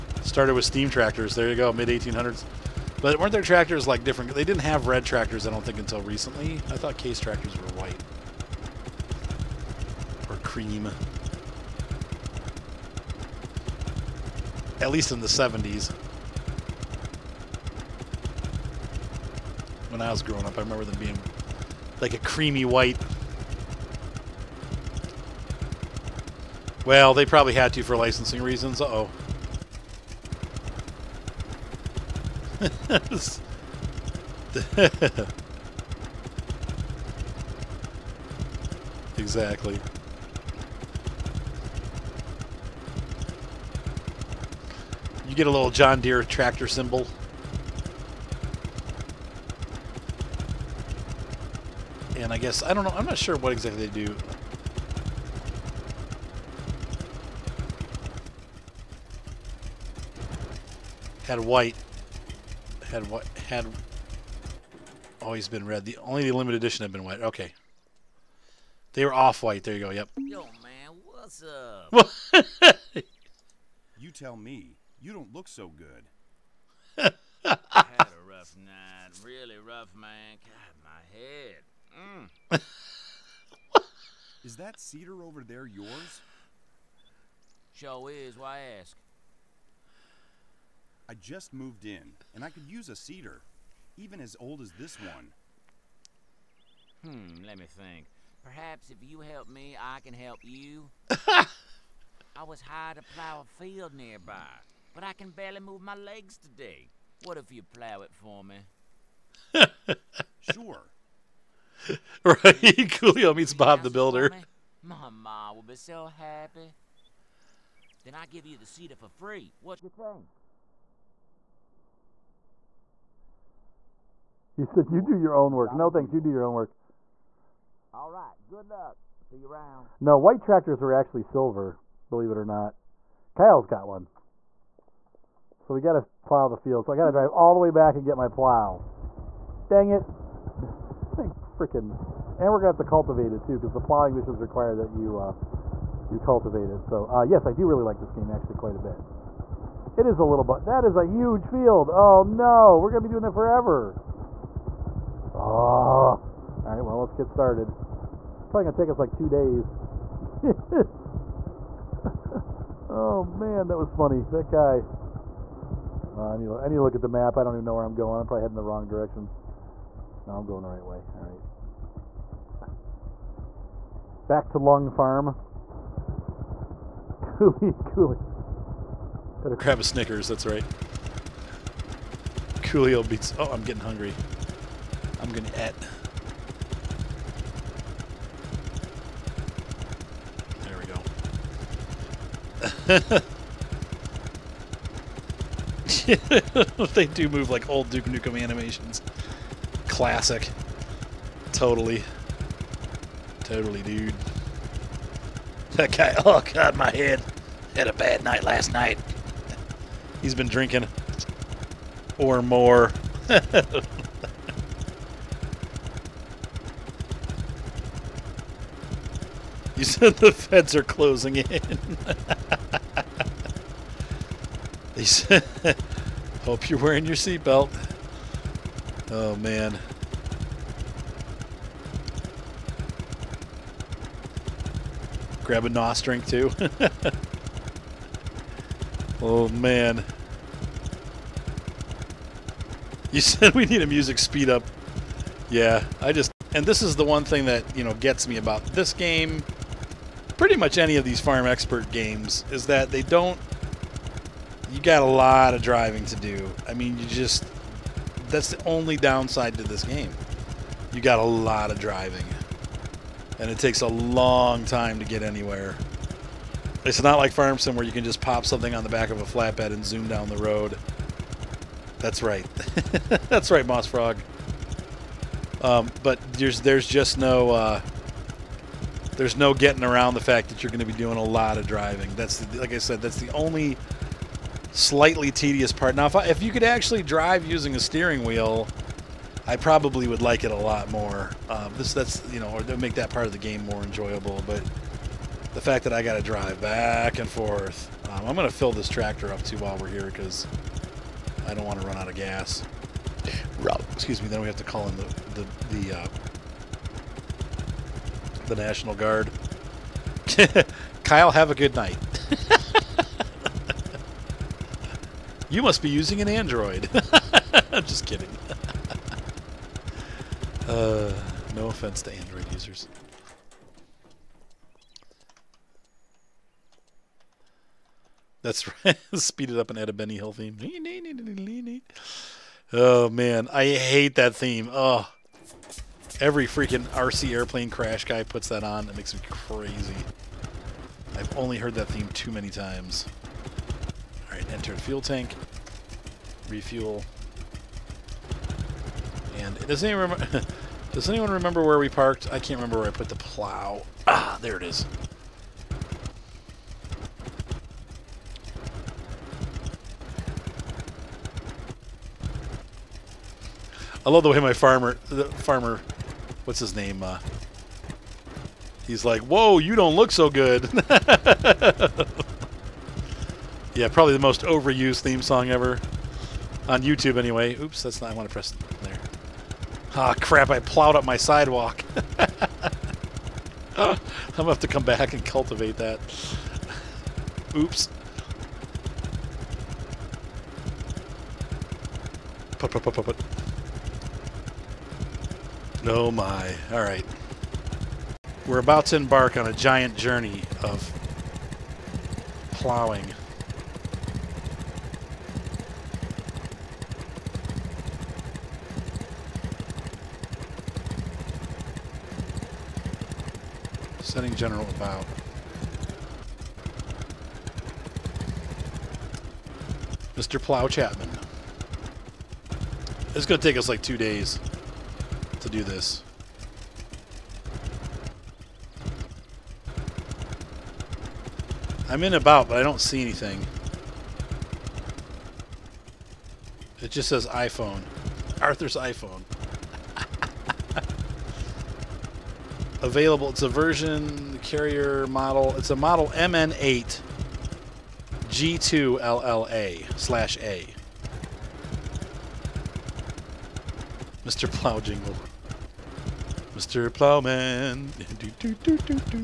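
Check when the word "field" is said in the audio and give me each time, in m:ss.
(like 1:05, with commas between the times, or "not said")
1:43, 2:16, 2:31.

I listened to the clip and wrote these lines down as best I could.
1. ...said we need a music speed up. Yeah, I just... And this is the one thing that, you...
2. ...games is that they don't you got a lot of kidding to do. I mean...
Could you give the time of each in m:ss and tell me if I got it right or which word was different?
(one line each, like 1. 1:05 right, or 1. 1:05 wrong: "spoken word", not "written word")
1. 4:03 right
2. 4:11 wrong: "driving", not "kidding".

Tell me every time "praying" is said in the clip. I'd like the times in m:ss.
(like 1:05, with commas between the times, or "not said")
not said.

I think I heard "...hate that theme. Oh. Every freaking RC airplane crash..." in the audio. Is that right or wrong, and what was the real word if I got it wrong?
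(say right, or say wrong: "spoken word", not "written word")
right.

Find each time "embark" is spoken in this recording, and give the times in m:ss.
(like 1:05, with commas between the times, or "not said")
6:38.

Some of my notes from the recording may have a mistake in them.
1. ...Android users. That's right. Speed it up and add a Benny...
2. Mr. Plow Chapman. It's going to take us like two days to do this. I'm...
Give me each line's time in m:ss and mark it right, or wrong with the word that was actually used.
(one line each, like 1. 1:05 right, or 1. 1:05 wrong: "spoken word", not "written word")
1. 5:22 right
2. 7:00 right.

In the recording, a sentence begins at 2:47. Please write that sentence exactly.
I don't even know where I'm going.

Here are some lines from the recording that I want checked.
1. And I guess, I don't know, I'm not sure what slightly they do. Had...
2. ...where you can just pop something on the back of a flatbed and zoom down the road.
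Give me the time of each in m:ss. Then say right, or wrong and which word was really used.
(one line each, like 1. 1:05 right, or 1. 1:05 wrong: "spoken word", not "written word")
1. 0:52 wrong: "exactly", not "slightly"
2. 4:27 right.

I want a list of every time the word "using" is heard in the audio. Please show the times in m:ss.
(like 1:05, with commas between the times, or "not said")
4:47, 5:15.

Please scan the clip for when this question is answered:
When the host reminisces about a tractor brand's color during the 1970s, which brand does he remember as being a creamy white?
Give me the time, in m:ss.
0:06.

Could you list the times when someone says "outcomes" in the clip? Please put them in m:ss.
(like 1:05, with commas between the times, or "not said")
not said.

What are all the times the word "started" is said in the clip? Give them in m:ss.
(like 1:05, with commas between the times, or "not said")
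0:00, 2:37.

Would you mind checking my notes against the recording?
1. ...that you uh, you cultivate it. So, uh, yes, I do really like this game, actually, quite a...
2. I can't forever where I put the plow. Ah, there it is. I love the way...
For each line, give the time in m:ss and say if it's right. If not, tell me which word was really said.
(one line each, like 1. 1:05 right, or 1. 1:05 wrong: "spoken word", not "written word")
1. 2:24 right
2. 5:52 wrong: "remember", not "forever".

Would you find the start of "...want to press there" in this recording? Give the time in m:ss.
6:18.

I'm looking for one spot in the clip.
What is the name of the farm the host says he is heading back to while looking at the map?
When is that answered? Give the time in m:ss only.
2:54.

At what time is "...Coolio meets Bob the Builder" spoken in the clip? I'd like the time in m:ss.
1:52.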